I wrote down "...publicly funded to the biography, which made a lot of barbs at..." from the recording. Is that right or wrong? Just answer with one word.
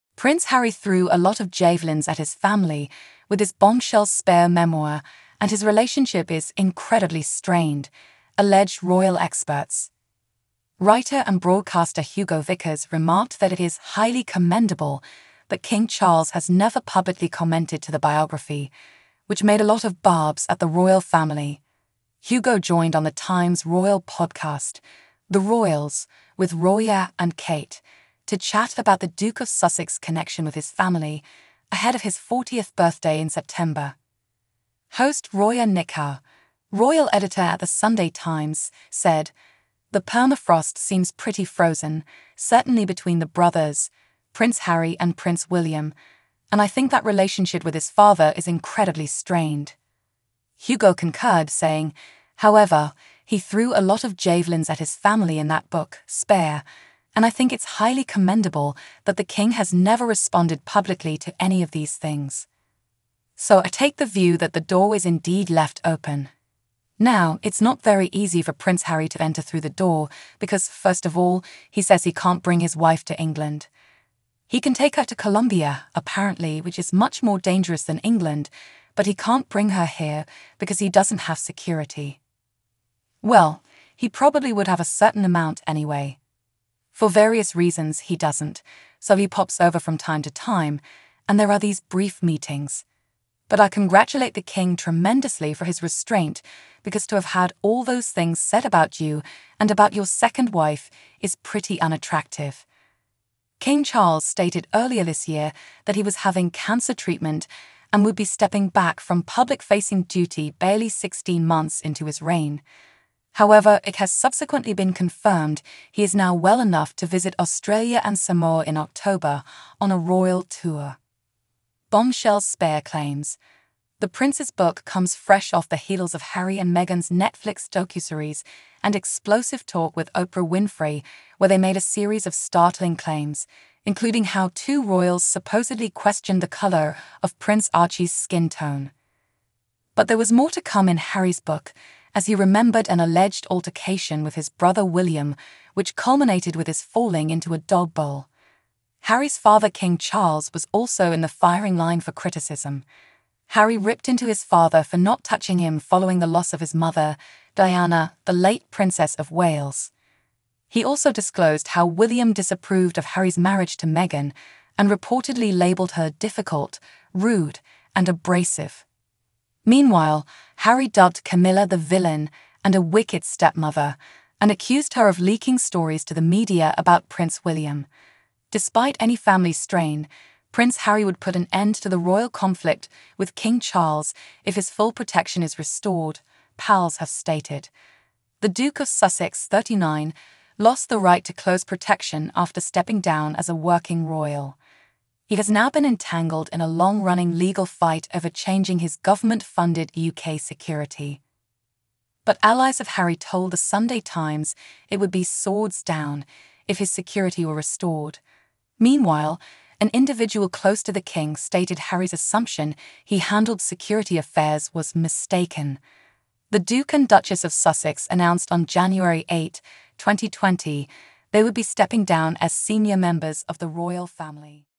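wrong.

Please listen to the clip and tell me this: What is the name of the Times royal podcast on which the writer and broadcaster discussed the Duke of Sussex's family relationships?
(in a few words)
The Royals.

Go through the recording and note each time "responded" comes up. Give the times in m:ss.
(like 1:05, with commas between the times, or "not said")
1:00.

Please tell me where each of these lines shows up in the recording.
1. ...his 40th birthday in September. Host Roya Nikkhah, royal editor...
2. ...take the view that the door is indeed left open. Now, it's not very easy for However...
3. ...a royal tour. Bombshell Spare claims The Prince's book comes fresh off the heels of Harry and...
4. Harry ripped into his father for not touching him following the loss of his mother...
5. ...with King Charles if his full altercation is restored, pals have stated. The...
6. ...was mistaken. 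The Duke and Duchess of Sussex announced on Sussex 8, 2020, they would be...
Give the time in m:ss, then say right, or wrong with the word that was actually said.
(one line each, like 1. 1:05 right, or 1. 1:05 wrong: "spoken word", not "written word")
1. 0:32 right
2. 1:03 wrong: "Prince", not "However"
3. 1:59 right
4. 2:33 right
5. 3:03 wrong: "protection", not "altercation"
6. 3:34 wrong: "January", not "Sussex".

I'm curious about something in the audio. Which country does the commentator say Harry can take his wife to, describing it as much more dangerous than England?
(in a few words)
Colombia.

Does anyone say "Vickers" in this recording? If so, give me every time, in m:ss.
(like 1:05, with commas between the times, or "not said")
0:12.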